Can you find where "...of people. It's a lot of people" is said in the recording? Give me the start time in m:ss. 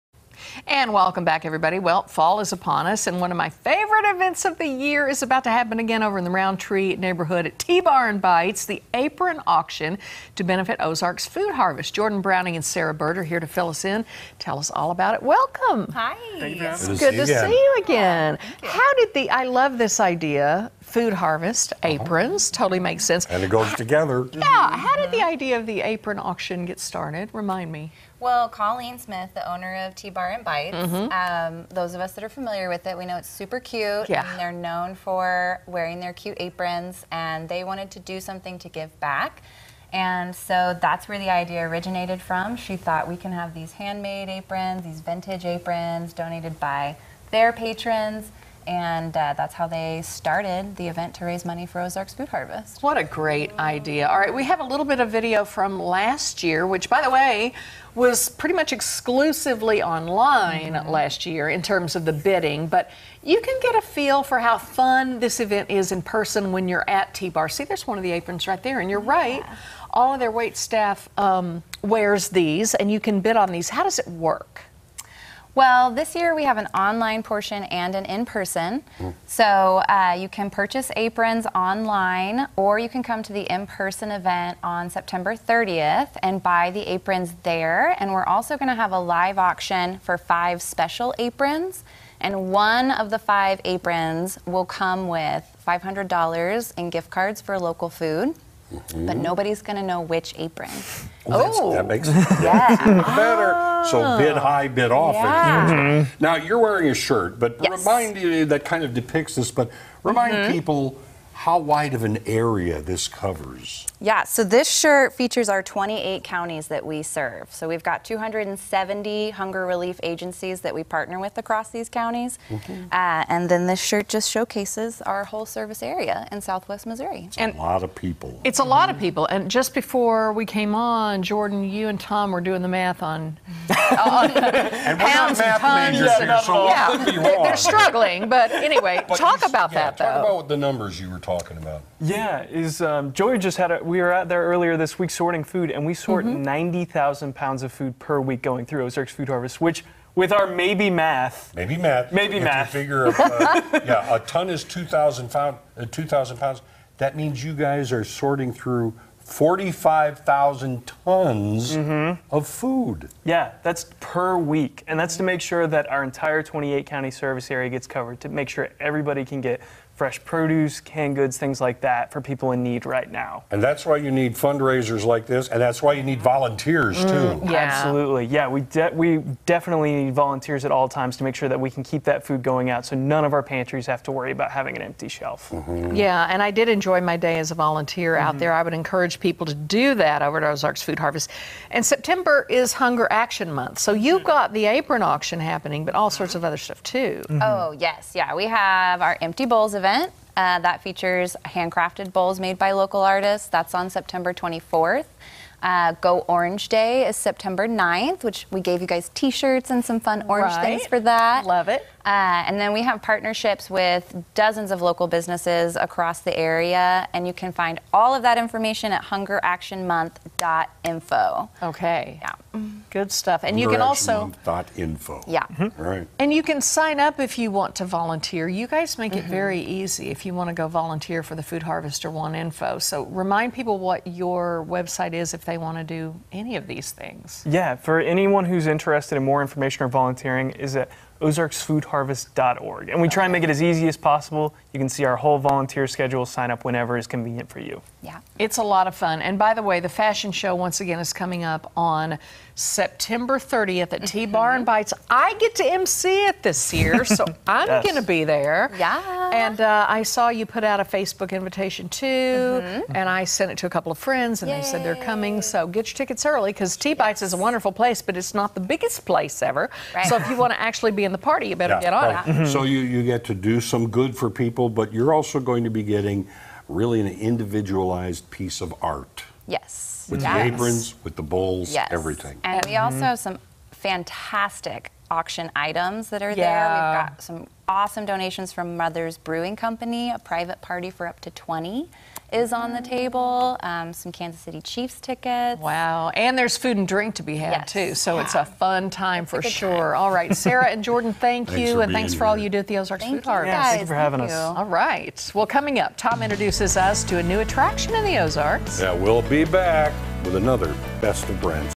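2:07.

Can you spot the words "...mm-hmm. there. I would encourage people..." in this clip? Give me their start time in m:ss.
3:08.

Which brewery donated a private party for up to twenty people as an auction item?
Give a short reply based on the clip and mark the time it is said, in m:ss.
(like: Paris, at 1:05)
Mother's Brewing Company, at 4:48.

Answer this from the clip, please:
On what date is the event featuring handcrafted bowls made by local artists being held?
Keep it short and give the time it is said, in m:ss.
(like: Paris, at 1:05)
September 24th, at 3:23.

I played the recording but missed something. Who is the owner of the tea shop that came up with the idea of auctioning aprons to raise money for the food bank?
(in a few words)
Colleen Smith.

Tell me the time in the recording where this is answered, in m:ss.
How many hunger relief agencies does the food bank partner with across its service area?
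1:58.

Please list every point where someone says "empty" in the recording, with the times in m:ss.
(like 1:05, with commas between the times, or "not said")
3:04, 3:19.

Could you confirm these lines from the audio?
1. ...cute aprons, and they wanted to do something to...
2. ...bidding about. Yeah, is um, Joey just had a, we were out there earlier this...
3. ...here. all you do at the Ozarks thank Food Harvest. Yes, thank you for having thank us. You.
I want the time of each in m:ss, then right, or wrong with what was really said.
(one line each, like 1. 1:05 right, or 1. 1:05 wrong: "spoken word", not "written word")
1. 0:36 right
2. 2:21 wrong: "talking", not "bidding"
3. 5:02 right.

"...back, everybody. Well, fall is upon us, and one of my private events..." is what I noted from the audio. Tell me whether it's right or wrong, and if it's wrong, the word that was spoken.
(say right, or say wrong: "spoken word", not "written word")
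wrong: "favorite", not "private".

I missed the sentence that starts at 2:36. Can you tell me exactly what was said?
That means you guys are sorting through 45,000 tons mm -hmm.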